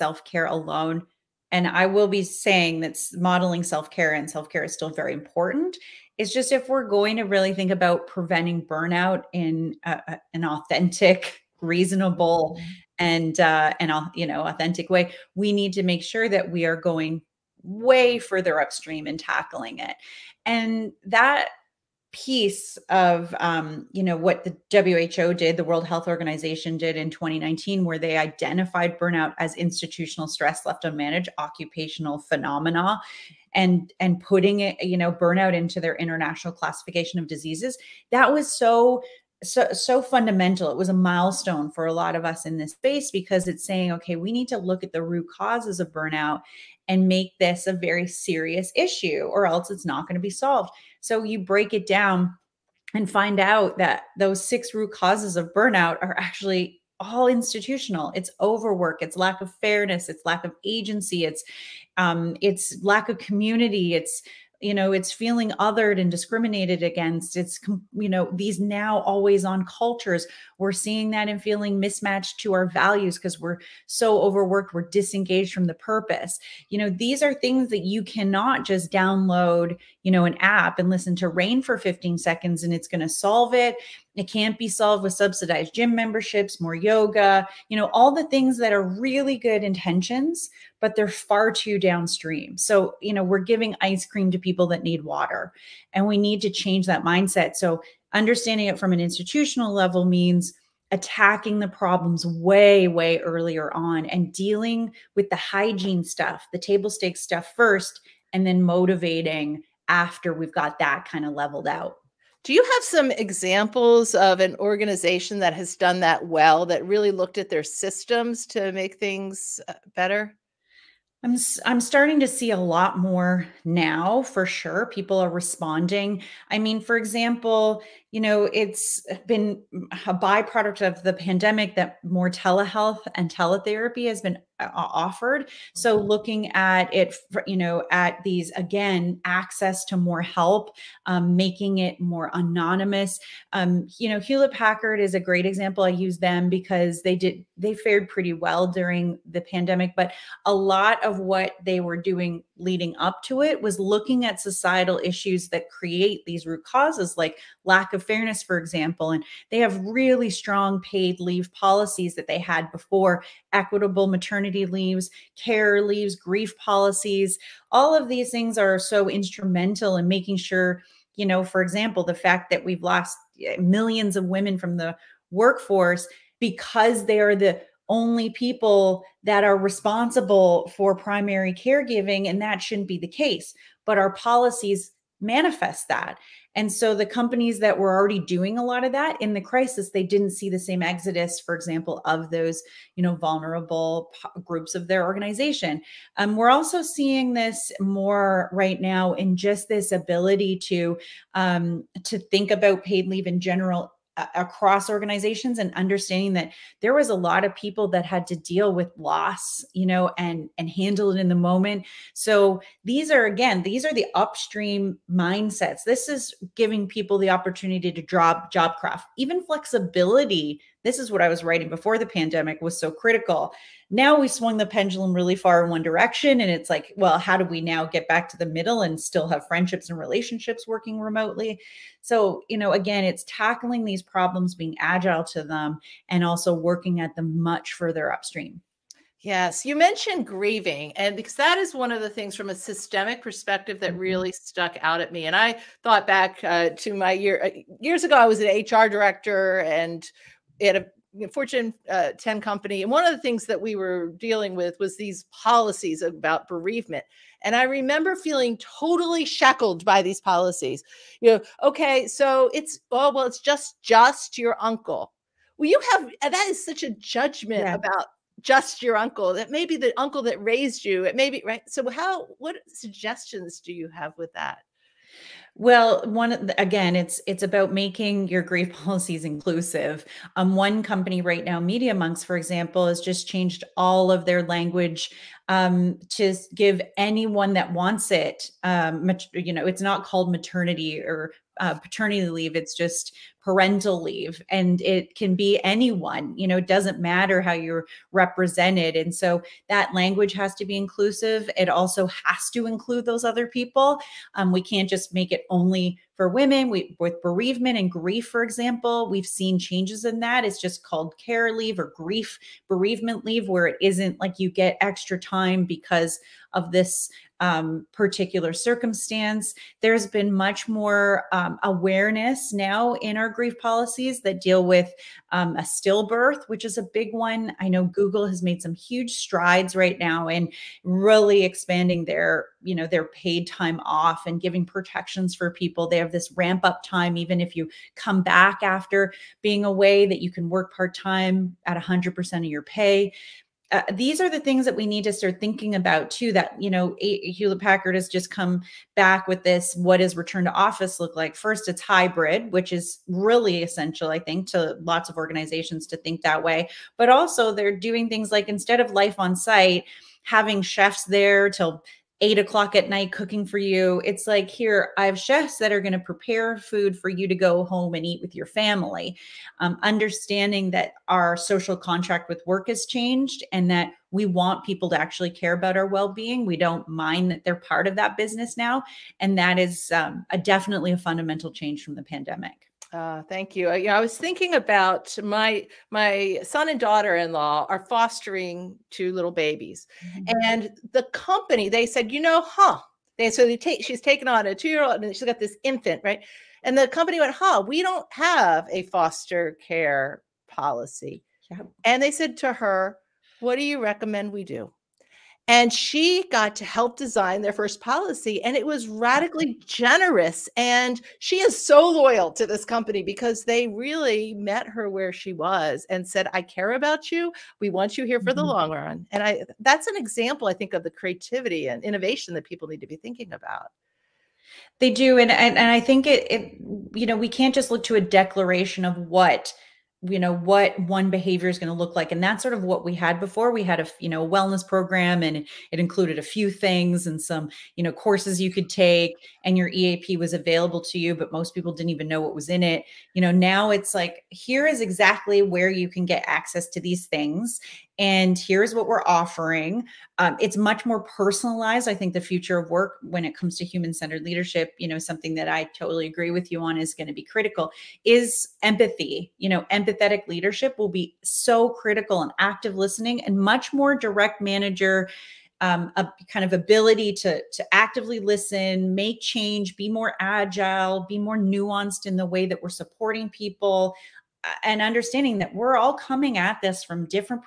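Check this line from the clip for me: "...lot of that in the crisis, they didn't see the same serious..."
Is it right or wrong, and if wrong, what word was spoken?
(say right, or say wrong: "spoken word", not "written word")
wrong: "exodus", not "serious".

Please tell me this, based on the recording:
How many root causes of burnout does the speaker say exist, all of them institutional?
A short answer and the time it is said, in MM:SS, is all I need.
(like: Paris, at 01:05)
6, at 00:54.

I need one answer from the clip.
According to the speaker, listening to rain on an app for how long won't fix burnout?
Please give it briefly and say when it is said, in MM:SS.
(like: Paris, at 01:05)
15 seconds, at 01:21.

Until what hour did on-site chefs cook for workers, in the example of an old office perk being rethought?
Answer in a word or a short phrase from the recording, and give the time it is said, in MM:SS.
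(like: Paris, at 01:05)
8 p.m., at 06:02.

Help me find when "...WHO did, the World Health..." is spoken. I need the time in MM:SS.
00:24.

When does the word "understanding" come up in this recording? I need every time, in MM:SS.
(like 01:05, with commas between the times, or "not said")
01:38, 03:25, 06:09, 07:54.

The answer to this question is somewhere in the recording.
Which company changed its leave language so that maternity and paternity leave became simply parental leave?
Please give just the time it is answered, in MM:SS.
04:41.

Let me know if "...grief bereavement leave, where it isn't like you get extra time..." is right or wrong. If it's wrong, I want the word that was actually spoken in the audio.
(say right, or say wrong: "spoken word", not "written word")
right.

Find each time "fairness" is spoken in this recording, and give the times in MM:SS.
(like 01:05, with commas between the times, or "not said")
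00:59, 02:38.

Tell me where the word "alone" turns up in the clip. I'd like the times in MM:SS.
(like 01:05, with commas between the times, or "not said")
00:00.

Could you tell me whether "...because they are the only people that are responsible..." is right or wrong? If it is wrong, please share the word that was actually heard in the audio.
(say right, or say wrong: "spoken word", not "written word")
right.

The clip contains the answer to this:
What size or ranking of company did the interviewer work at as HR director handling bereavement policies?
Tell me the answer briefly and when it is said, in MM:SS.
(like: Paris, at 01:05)
Fortune 10, at 04:11.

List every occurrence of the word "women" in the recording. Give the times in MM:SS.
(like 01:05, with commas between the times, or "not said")
02:54, 05:06.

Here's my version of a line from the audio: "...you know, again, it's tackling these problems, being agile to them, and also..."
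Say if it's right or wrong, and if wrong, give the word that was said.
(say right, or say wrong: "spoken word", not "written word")
right.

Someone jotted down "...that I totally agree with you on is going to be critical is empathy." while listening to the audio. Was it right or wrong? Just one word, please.
right.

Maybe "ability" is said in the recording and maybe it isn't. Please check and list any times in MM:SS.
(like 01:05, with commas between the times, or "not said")
03:19, 07:46.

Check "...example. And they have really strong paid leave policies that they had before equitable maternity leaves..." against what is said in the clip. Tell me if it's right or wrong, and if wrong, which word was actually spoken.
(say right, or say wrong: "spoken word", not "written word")
right.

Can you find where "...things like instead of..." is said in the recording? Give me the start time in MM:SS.
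05:58.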